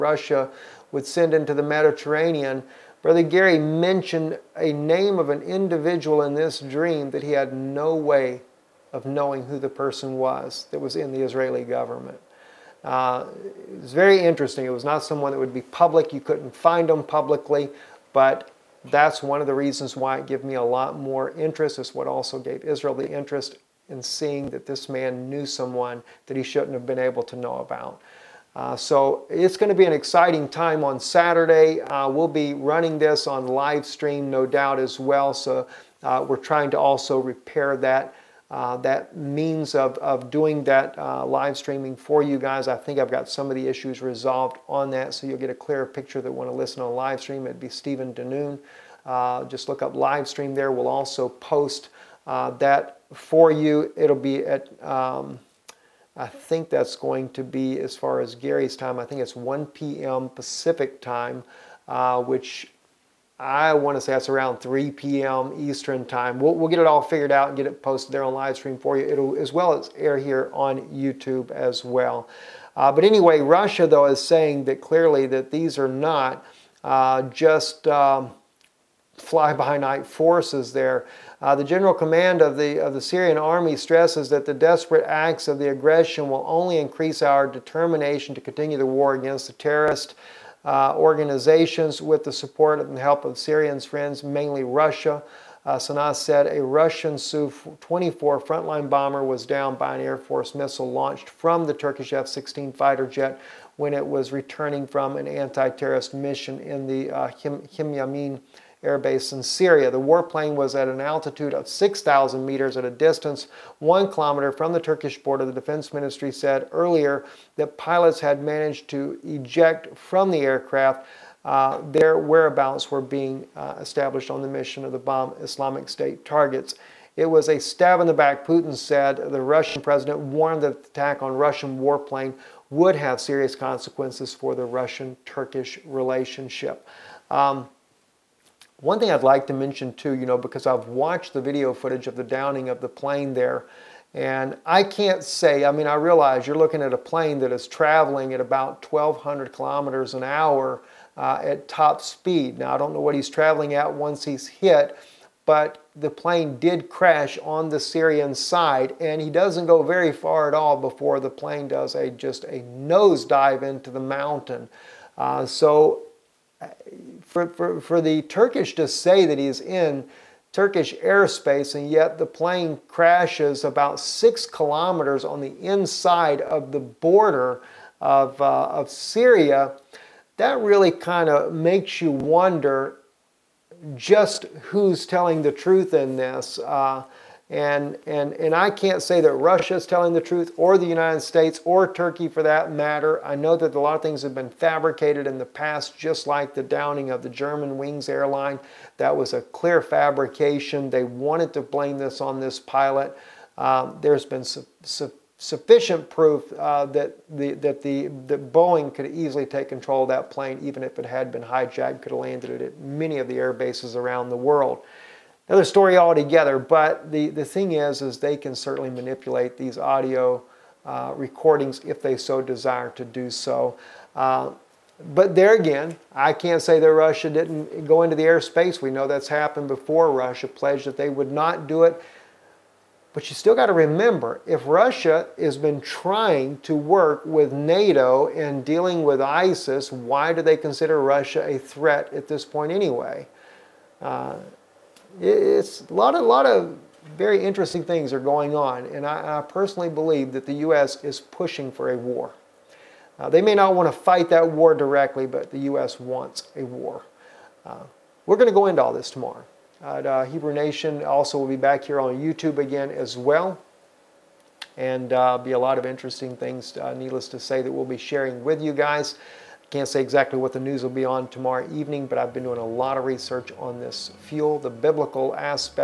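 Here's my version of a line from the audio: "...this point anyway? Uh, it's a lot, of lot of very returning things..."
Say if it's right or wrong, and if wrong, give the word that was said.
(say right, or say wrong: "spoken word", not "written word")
wrong: "interesting", not "returning".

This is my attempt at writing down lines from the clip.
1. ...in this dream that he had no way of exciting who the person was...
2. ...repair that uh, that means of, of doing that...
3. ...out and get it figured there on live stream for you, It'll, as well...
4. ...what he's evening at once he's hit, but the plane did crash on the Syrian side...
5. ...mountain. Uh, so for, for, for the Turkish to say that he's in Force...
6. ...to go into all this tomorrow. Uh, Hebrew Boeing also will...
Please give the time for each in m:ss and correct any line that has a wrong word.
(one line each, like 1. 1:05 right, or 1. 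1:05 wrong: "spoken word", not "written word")
1. 0:06 wrong: "knowing", not "exciting"
2. 0:37 right
3. 1:07 wrong: "posted", not "figured"
4. 2:33 wrong: "traveling", not "evening"
5. 2:43 wrong: "Turkish", not "Force"
6. 4:18 wrong: "Nation", not "Boeing".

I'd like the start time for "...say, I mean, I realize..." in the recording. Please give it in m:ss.
2:25.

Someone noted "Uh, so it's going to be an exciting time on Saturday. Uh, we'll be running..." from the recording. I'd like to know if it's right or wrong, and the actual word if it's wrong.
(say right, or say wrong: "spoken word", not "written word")
right.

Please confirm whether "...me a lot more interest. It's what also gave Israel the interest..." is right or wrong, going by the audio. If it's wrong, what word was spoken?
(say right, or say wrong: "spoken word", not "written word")
right.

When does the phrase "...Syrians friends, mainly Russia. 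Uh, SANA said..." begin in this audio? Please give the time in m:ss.
1:33.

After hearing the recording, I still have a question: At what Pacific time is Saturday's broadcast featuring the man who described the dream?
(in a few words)
1 p.m.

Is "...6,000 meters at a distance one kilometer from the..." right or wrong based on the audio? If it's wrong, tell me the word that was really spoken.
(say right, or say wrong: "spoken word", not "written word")
right.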